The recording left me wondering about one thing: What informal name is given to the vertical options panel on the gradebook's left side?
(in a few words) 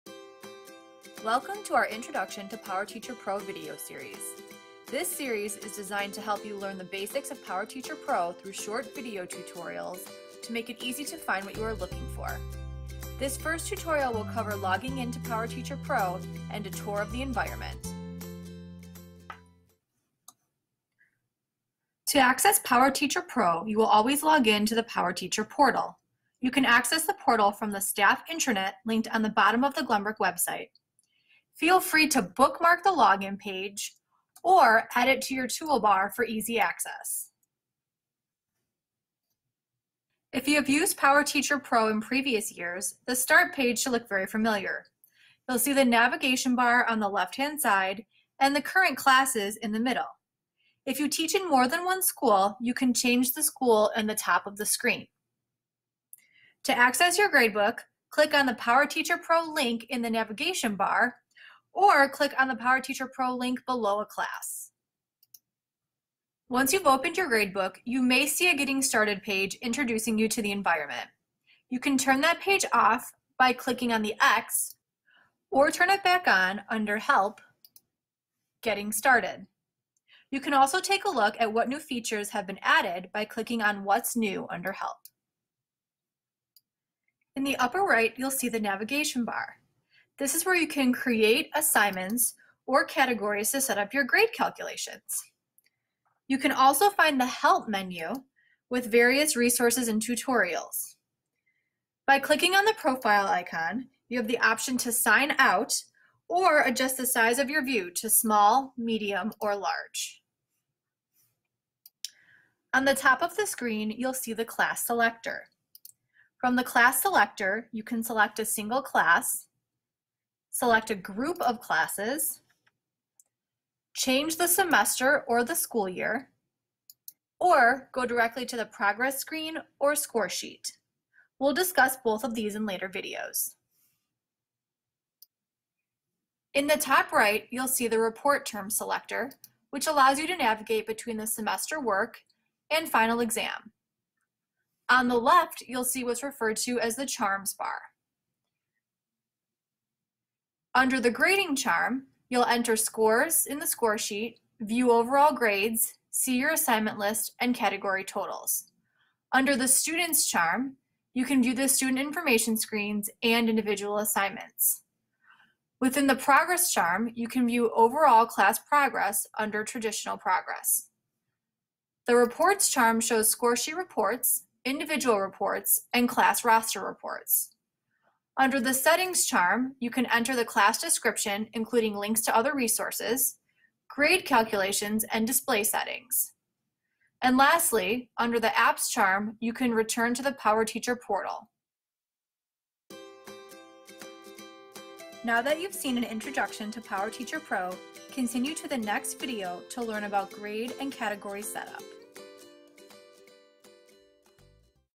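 Charms bar.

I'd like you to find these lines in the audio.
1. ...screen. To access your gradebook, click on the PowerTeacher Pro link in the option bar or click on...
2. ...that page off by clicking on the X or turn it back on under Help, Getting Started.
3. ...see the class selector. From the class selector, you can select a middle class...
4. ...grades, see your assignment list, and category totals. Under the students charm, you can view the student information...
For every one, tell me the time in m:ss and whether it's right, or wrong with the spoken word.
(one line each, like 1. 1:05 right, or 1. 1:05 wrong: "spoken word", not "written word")
1. 0:54 wrong: "navigation", not "option"
2. 1:12 right
3. 1:54 wrong: "single", not "middle"
4. 2:35 right.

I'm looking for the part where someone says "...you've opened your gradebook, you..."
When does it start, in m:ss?
1:06.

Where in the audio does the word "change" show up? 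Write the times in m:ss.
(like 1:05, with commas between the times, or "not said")
0:52, 2:03.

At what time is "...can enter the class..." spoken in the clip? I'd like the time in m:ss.
2:59.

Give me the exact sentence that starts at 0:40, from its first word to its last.
If you have used PowerTeacher Pro in previous years, the Start page should look very familiar.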